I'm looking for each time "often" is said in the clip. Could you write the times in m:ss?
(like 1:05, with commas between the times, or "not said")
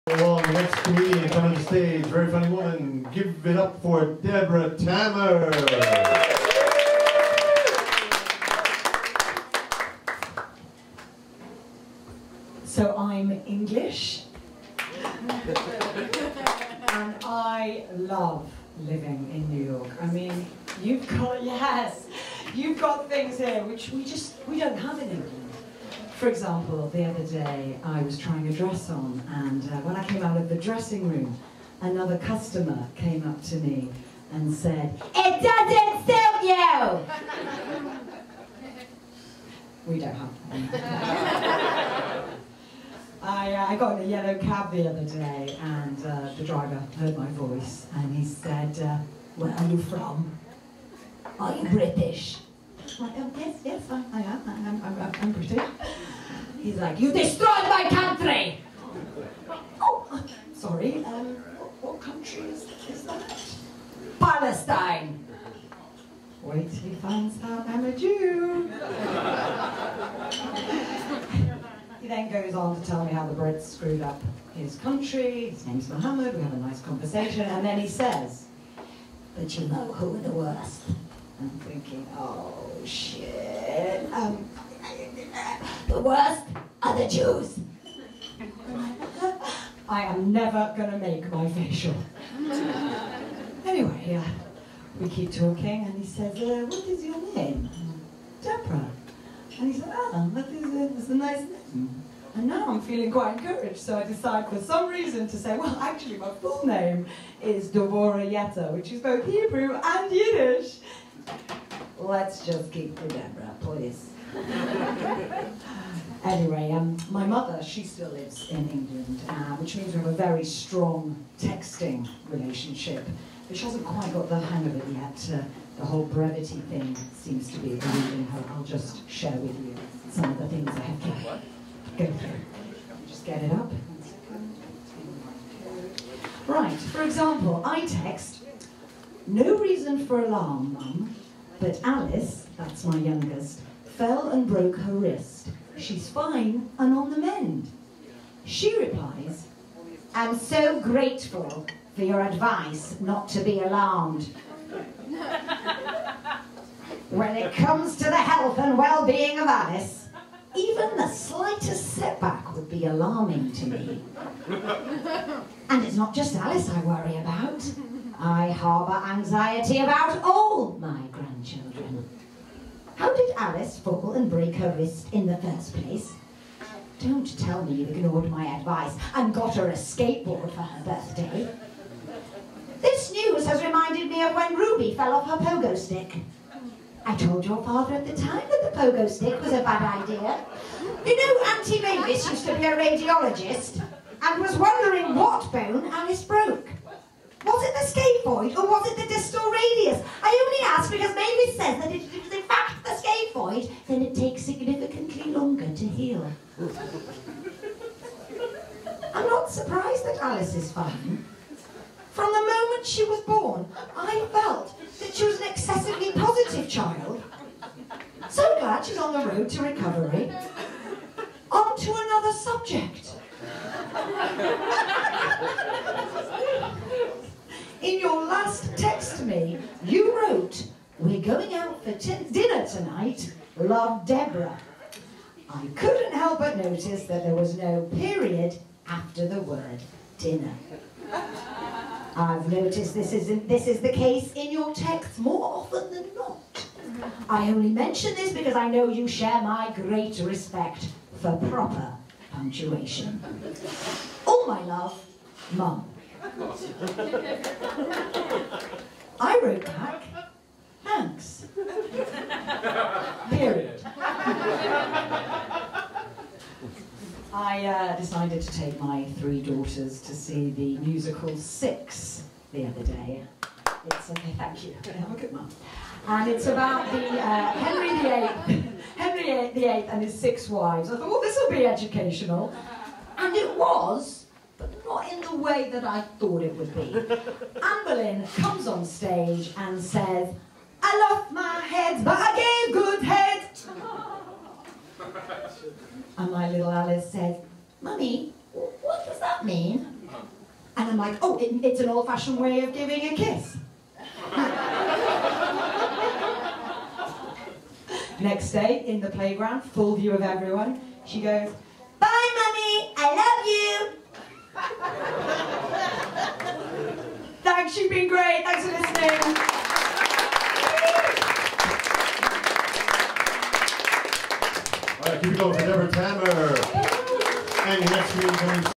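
4:05.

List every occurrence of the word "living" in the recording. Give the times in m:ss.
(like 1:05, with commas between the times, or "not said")
0:18.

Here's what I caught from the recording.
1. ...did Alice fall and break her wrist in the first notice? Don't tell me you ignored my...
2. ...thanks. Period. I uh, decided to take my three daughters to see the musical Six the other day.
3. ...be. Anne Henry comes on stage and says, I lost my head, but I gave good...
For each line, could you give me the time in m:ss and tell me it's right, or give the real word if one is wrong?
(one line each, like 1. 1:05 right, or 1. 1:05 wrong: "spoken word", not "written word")
1. 2:53 wrong: "place", not "notice"
2. 4:20 right
3. 4:46 wrong: "Boleyn", not "Henry".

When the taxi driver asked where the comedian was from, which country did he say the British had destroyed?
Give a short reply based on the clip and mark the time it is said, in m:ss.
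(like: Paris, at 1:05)
Palestine, at 1:04.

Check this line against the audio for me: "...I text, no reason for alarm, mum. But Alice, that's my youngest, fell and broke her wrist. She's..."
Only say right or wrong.
right.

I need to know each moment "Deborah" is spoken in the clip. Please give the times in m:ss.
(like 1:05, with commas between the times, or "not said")
0:04, 1:38, 1:53, 3:54, 5:25.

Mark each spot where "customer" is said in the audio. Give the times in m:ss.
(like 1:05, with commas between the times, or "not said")
0:32.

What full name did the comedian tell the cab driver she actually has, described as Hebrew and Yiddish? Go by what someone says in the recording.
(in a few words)
Devorah Yetta.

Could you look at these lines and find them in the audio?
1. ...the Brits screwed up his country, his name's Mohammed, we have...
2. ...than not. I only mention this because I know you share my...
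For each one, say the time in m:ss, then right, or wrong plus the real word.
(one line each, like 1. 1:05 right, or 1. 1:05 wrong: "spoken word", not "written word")
1. 1:13 right
2. 4:05 right.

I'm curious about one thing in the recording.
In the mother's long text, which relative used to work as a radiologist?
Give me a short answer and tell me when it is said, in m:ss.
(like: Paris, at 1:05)
Auntie Mavis, at 3:11.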